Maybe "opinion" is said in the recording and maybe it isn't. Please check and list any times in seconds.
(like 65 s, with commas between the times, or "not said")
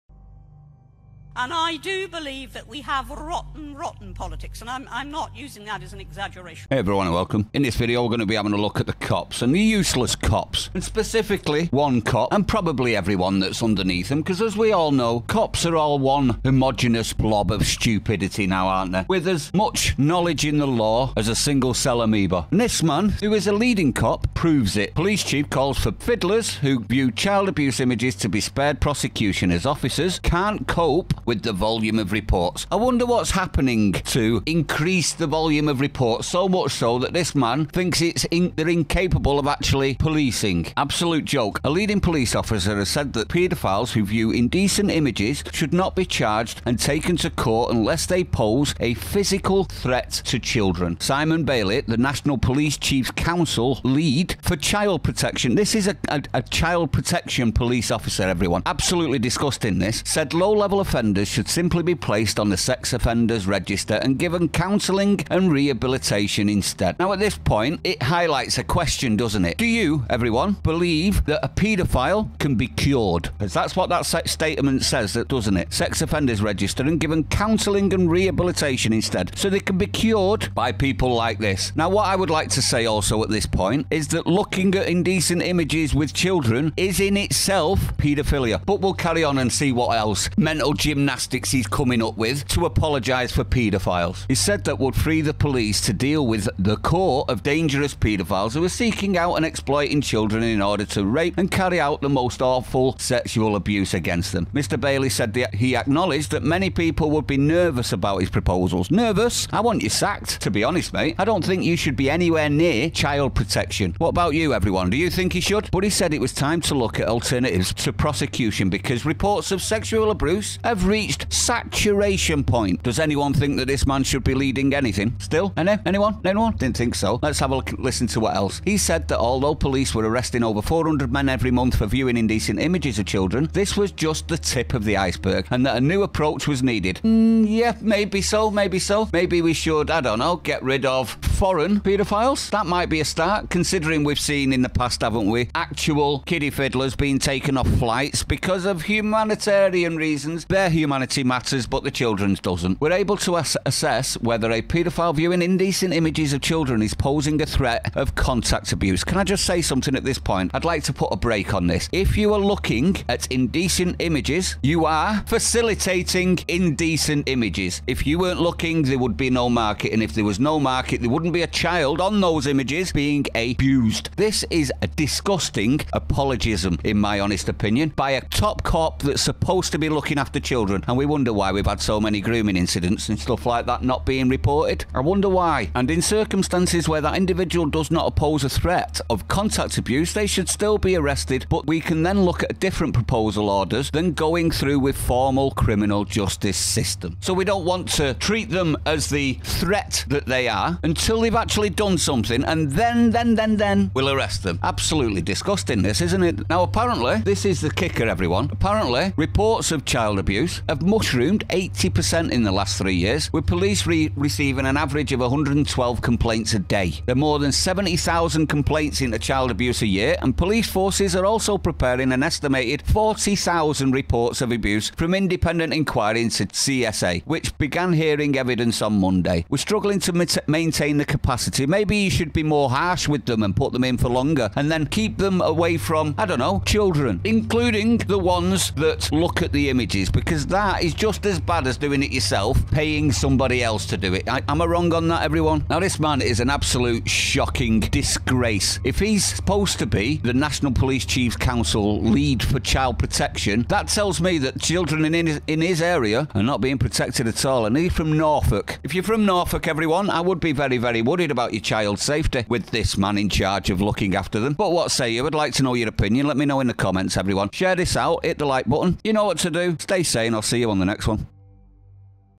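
177 s, 265 s.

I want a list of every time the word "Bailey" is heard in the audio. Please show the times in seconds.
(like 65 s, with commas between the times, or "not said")
51 s, 104 s.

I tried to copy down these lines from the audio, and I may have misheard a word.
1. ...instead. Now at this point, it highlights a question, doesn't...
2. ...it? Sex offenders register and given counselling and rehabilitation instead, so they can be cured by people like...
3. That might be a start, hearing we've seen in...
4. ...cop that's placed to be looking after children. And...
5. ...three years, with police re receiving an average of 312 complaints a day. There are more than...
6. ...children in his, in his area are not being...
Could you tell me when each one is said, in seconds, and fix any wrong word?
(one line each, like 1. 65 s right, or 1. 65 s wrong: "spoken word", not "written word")
1. 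66 s right
2. 75 s right
3. 142 s wrong: "considering", not "hearing"
4. 178 s wrong: "supposed", not "placed"
5. 212 s wrong: "112", not "312"
6. 254 s right.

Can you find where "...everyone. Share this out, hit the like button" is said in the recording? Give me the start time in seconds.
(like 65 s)
267 s.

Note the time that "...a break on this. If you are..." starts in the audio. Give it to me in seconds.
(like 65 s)
161 s.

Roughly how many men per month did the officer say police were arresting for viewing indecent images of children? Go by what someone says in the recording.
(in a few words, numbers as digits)
400.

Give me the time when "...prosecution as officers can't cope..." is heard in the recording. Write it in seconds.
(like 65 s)
28 s.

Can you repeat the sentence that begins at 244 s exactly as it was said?
I, am I wrong on that, everyone?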